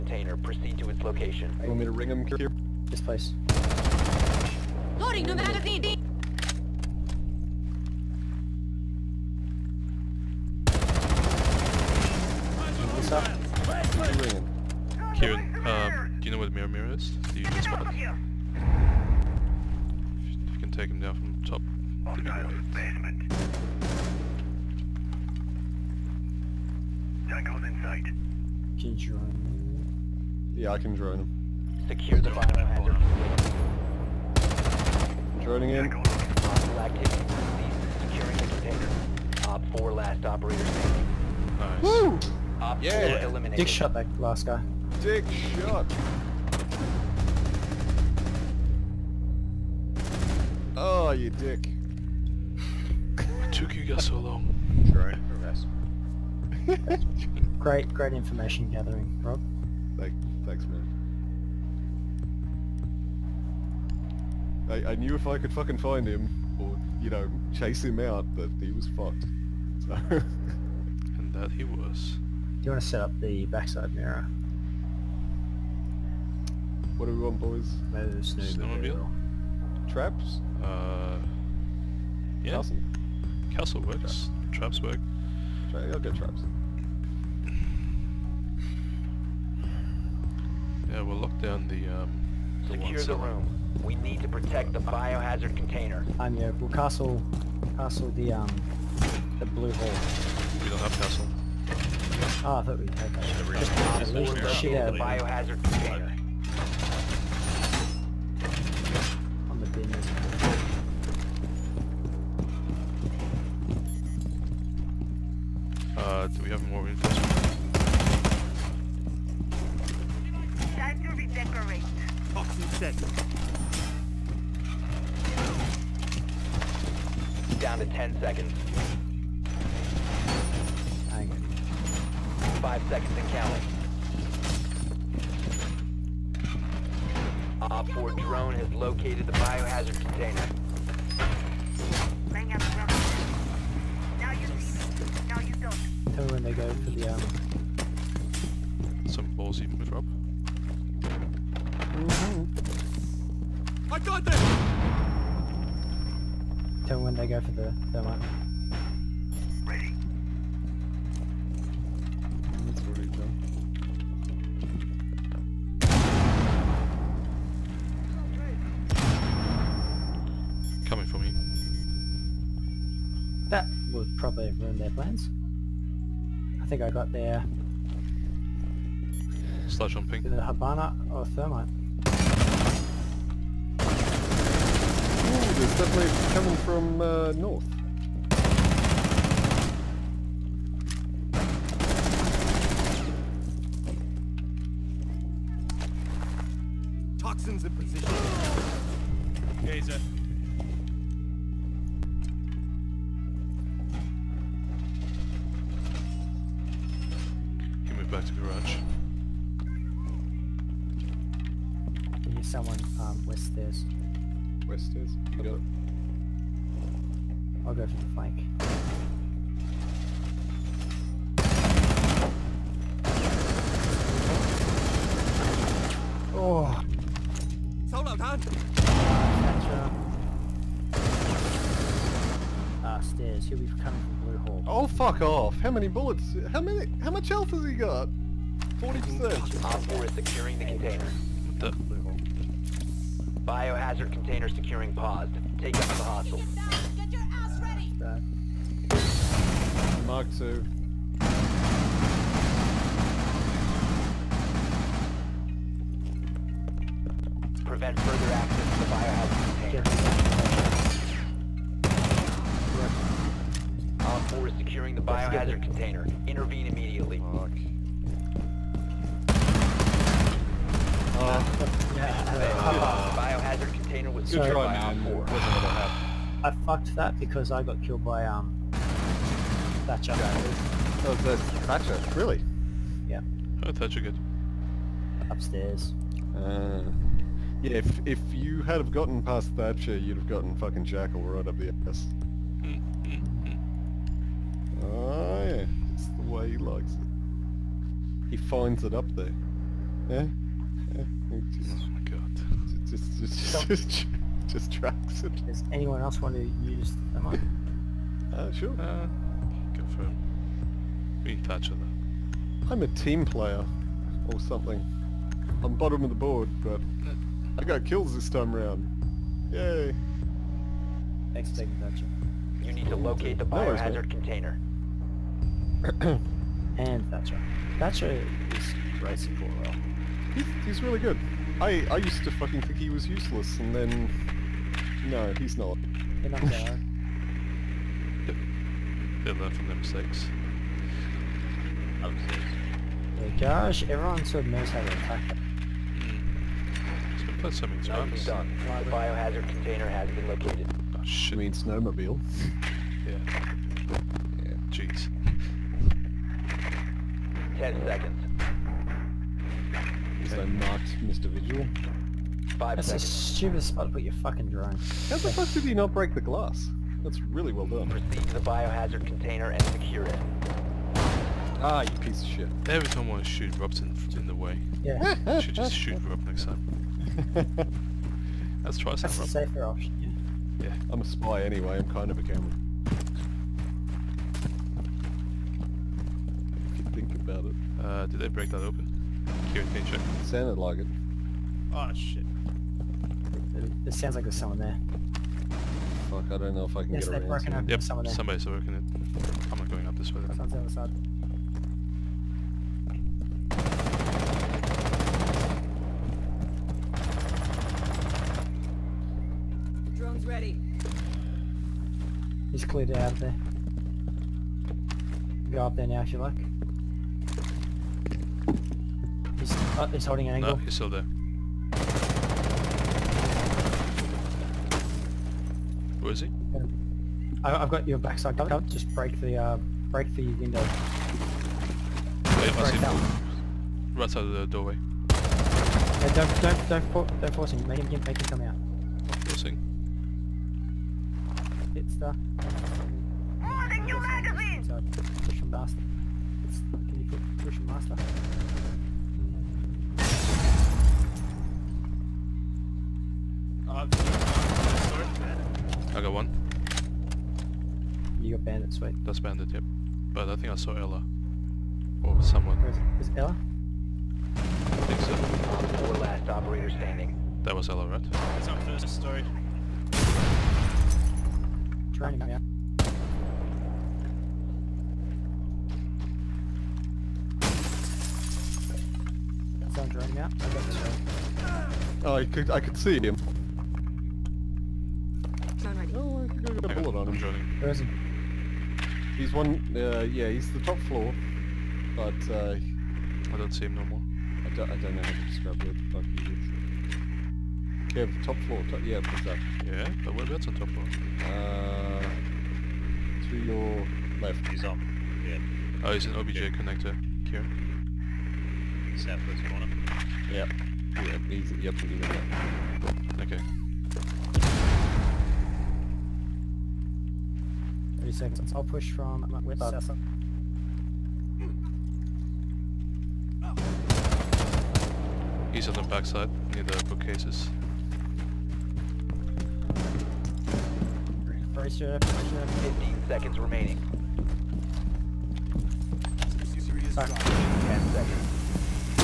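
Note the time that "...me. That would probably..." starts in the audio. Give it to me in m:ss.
2:51.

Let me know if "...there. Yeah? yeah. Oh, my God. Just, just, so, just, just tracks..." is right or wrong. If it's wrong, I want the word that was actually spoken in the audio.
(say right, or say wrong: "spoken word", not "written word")
right.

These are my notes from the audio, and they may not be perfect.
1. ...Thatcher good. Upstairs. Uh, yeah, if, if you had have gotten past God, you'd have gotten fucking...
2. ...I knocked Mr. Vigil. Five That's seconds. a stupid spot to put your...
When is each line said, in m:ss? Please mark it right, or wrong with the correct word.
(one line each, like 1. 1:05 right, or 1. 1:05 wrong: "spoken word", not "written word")
1. 4:43 wrong: "Thatcher", not "God"
2. 6:00 right.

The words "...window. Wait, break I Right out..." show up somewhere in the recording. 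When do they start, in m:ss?
7:10.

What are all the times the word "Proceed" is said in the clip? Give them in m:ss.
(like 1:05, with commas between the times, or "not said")
0:00, 6:07.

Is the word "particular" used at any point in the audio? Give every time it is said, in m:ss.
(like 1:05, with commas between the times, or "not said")
not said.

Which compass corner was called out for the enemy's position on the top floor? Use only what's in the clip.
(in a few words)
Southwest.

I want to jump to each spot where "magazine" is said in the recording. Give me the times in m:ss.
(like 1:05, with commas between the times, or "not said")
0:05, 7:23.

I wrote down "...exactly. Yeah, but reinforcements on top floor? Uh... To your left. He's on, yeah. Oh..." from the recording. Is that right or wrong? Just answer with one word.
wrong.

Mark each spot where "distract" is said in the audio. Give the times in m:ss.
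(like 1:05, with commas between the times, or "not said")
not said.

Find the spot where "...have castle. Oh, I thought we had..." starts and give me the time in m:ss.
1:40.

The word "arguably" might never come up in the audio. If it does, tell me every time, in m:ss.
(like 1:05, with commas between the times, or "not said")
not said.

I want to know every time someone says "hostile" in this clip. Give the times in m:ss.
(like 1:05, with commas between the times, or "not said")
0:35, 4:06.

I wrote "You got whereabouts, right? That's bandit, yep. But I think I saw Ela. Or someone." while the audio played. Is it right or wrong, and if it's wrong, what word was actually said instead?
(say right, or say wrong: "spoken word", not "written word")
wrong: "bandits", not "whereabouts".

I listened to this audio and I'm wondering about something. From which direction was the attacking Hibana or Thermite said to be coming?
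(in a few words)
North.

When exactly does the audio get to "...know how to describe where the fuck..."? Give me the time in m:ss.
8:14.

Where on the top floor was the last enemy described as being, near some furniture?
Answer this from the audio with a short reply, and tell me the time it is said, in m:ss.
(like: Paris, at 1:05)
Near the bookcases, at 8:46.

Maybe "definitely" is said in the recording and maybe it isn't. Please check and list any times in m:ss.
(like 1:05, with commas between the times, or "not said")
3:05.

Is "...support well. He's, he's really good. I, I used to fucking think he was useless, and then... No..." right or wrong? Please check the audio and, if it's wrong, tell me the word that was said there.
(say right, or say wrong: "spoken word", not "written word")
right.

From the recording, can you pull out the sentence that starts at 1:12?
Do you want to set up the backside mirror?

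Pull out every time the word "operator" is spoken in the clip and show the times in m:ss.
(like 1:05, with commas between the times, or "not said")
0:40, 7:46.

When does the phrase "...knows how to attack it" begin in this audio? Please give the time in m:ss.
5:44.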